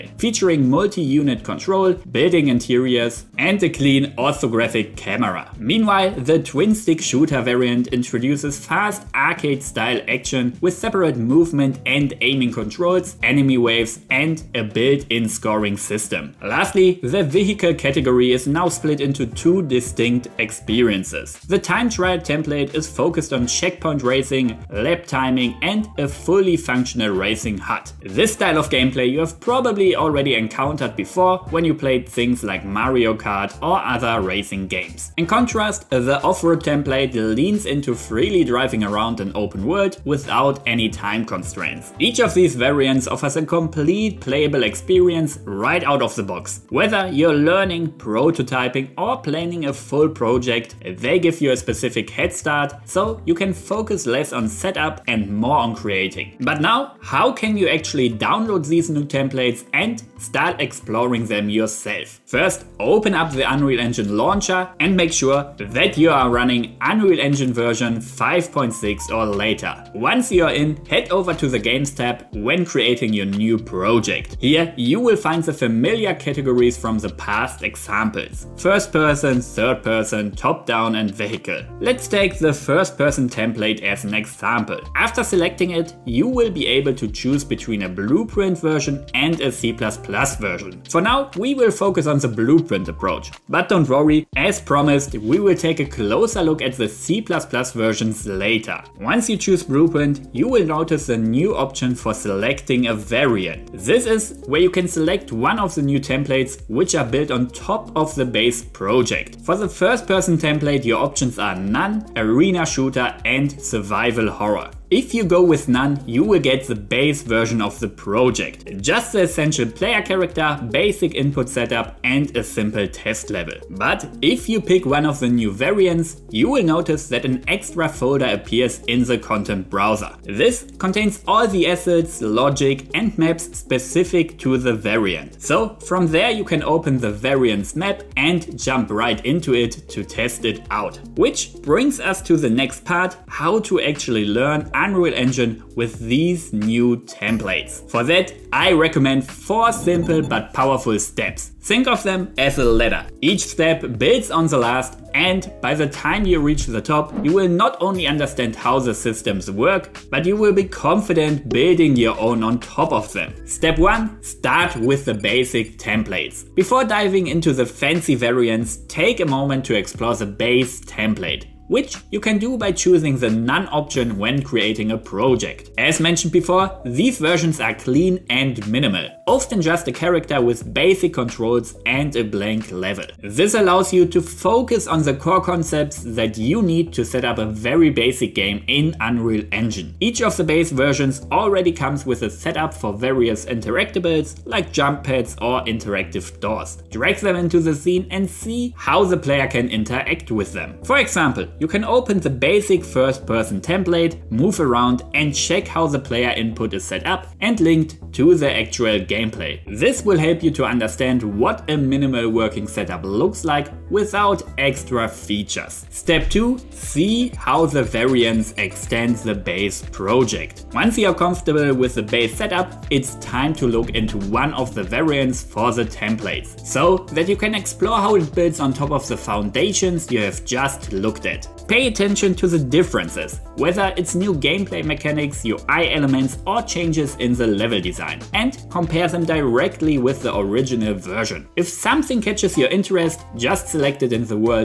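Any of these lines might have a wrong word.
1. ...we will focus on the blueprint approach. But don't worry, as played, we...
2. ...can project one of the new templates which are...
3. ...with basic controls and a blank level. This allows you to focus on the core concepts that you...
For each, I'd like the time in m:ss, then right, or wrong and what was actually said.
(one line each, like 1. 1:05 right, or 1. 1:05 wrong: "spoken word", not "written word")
1. 1:31 wrong: "promised", not "played"
2. 1:44 wrong: "select", not "project"
3. 3:00 right.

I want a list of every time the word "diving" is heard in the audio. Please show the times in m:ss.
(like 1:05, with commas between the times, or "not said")
2:46.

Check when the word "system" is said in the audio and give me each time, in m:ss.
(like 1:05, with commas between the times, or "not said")
0:15, 2:38.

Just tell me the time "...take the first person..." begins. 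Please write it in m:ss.
1:22.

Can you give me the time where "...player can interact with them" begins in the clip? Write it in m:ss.
3:19.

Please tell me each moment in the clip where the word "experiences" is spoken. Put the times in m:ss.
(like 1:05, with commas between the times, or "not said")
0:20, 0:44.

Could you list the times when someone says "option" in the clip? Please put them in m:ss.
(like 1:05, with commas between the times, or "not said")
1:41, 1:51, 2:53.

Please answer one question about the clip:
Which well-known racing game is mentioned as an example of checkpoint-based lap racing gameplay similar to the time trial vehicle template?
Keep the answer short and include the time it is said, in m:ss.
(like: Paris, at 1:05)
Mario Kart, at 0:32.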